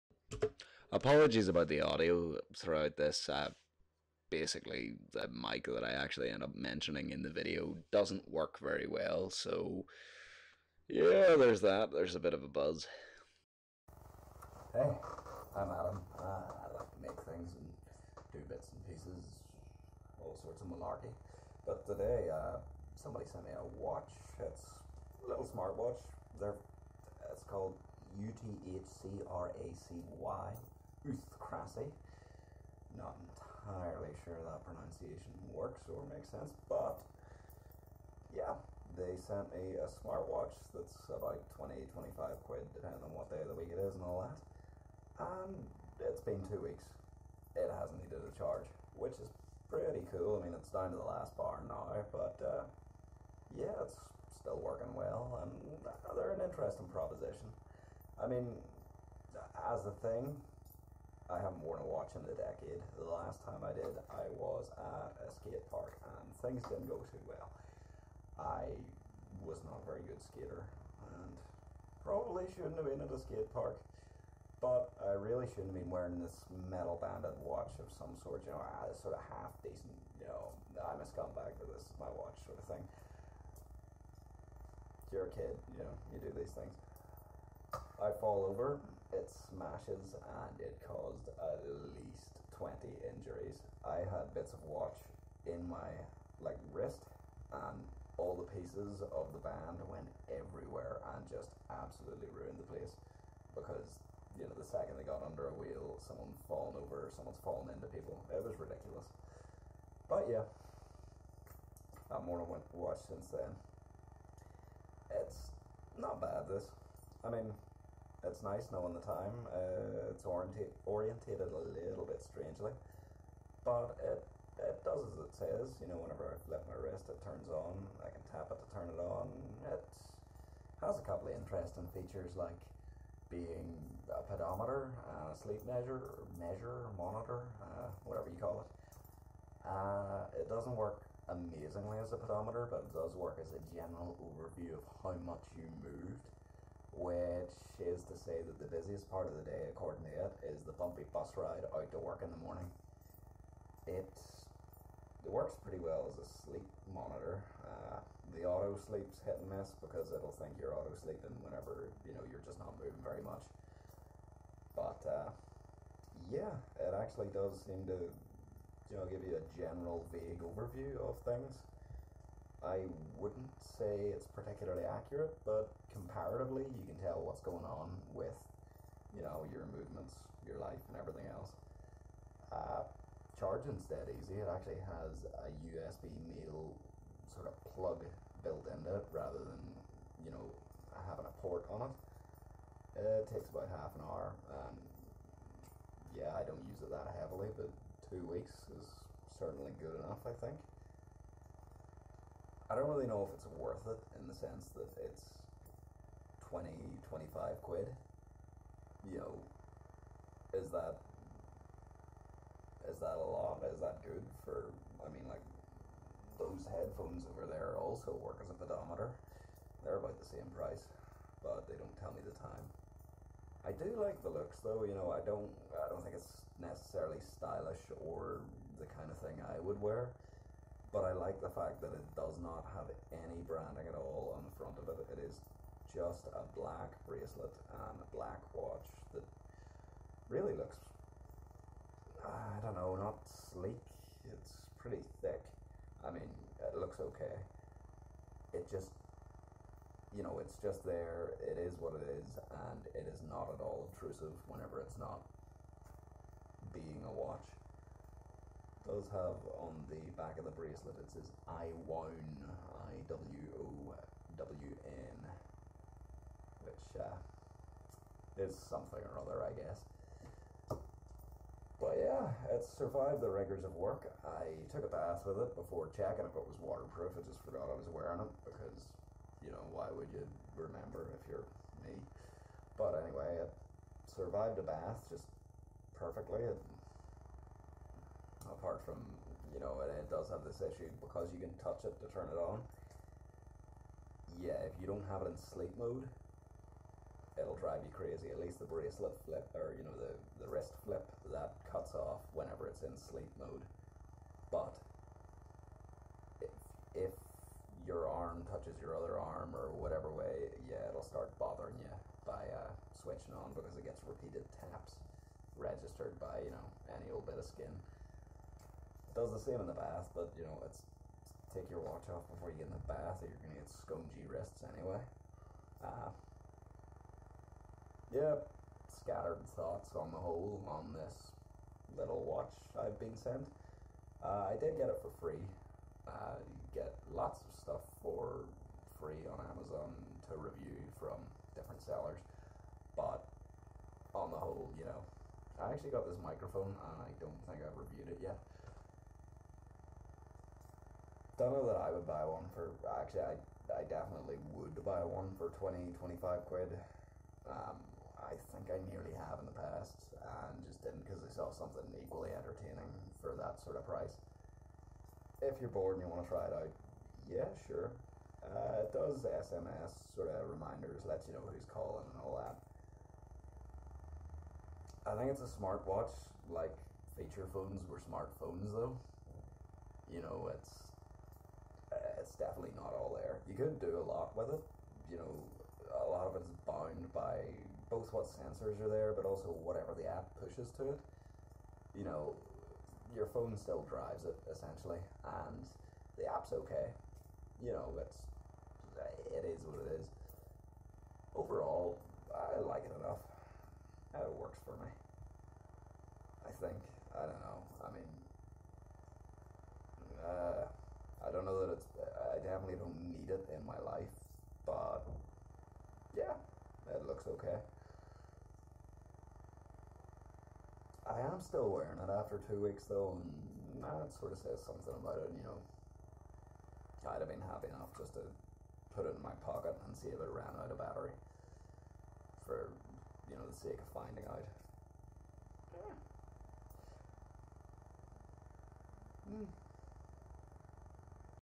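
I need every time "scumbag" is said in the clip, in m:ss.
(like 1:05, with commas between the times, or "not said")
1:21.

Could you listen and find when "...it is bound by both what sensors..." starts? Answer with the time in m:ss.
6:26.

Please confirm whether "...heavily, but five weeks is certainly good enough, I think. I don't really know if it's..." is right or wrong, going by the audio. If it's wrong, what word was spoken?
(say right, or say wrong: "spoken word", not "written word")
wrong: "two", not "five".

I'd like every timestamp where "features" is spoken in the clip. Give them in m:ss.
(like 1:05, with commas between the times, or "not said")
2:11, 6:17.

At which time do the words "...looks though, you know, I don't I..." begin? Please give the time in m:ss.
3:44.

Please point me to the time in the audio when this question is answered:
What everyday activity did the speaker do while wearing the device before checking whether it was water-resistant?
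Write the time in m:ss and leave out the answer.
4:34.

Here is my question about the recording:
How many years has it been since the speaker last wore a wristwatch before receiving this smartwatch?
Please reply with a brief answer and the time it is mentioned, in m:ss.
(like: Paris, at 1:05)
a decade, at 1:02.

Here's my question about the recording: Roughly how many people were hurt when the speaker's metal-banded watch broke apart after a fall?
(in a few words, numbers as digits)
at least 20.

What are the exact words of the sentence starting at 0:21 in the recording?
But today, uh, somebody sent me a watch.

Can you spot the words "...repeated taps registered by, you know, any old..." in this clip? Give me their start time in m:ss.
5:14.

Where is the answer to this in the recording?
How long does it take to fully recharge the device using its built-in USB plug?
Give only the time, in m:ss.
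3:13.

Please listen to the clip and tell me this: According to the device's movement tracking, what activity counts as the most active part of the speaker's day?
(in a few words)
bumpy bus ride.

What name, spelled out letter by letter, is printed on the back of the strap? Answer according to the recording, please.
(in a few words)
IWOWN.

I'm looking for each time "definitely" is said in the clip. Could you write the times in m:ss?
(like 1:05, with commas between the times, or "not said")
5:53, 6:22.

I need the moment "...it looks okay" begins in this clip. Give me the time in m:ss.
4:06.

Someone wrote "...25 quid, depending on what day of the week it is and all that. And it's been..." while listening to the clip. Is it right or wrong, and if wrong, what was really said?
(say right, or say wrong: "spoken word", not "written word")
right.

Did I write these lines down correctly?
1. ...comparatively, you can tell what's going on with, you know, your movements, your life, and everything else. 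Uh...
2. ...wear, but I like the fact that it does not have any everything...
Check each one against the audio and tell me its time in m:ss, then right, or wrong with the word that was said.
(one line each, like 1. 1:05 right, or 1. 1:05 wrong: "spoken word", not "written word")
1. 2:55 right
2. 3:49 wrong: "branding", not "everything".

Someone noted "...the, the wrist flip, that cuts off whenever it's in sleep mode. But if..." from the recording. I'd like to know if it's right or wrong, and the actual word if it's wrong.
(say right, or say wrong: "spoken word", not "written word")
right.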